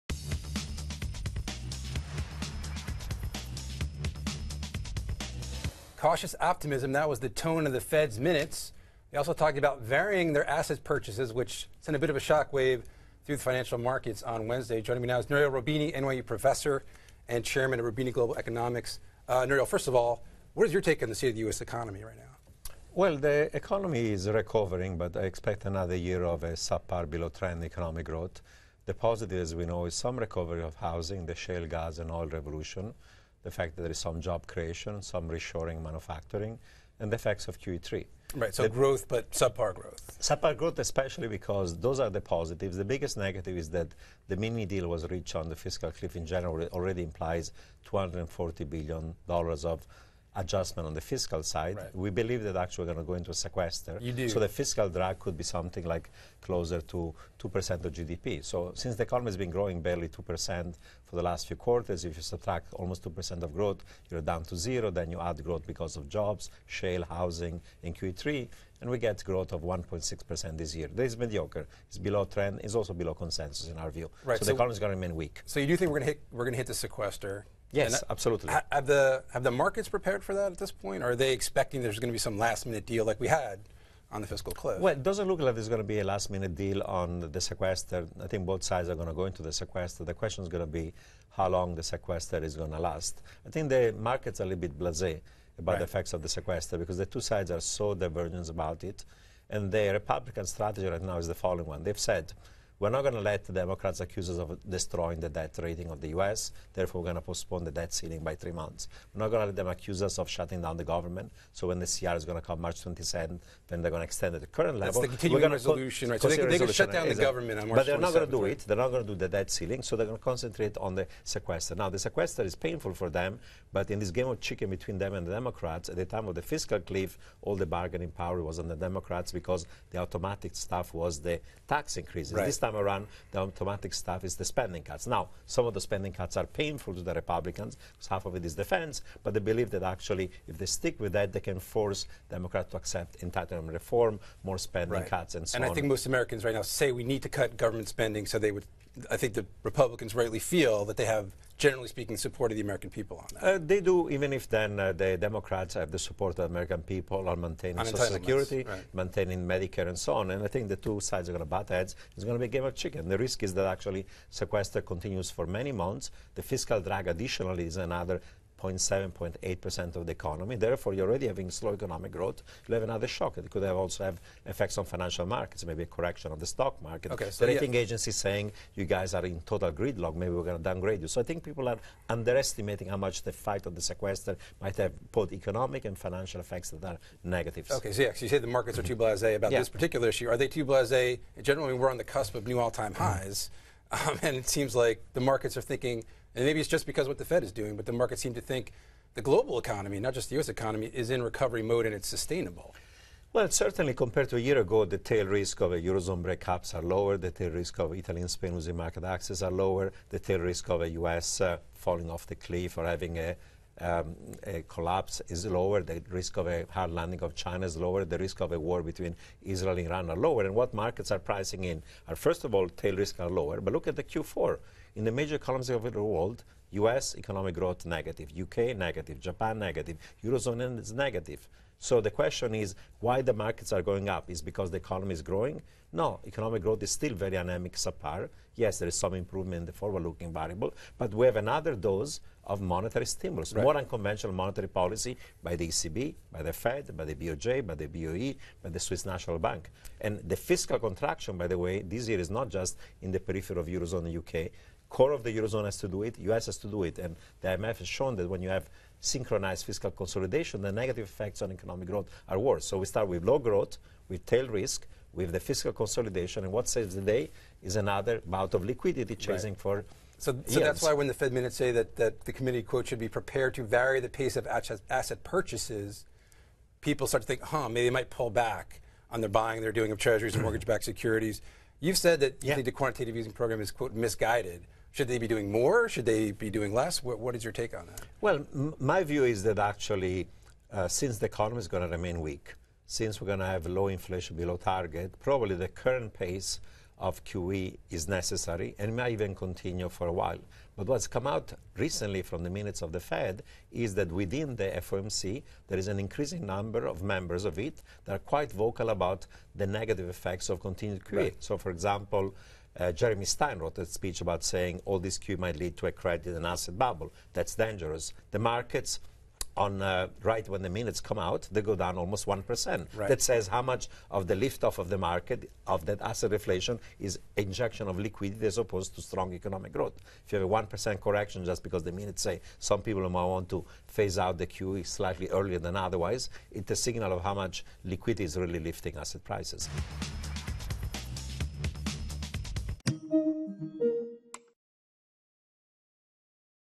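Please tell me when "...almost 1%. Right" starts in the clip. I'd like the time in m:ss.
5:21.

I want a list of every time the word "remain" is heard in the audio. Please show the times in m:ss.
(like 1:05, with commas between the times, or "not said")
1:14, 4:51.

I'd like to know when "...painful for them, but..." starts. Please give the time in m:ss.
2:02.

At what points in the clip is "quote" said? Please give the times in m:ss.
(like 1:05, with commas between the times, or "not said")
4:32, 4:43.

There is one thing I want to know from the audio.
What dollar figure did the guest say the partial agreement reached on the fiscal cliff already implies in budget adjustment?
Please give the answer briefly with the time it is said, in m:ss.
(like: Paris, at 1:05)
$240 billion, at 0:47.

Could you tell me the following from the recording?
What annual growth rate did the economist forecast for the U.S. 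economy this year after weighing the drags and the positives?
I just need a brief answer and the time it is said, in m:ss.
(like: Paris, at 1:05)
1.6%, at 1:09.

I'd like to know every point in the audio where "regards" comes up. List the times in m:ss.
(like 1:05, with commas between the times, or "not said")
not said.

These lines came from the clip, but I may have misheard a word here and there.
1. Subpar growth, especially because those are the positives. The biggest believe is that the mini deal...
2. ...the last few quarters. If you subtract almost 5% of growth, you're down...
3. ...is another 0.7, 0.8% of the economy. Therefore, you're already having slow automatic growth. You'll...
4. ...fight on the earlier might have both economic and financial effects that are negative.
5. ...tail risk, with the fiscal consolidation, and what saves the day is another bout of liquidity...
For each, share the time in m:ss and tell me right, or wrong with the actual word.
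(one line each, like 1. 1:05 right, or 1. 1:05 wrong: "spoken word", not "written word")
1. 0:40 wrong: "negative", not "believe"
2. 1:01 wrong: "2", not "5"
3. 2:47 wrong: "economic", not "automatic"
4. 3:03 wrong: "sequester", not "earlier"
5. 4:24 right.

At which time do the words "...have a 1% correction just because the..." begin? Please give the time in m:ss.
5:30.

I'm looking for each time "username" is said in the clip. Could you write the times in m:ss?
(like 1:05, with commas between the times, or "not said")
not said.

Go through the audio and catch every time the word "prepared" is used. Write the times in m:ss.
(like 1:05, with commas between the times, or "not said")
1:19, 4:33.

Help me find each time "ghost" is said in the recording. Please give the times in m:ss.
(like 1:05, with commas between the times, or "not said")
not said.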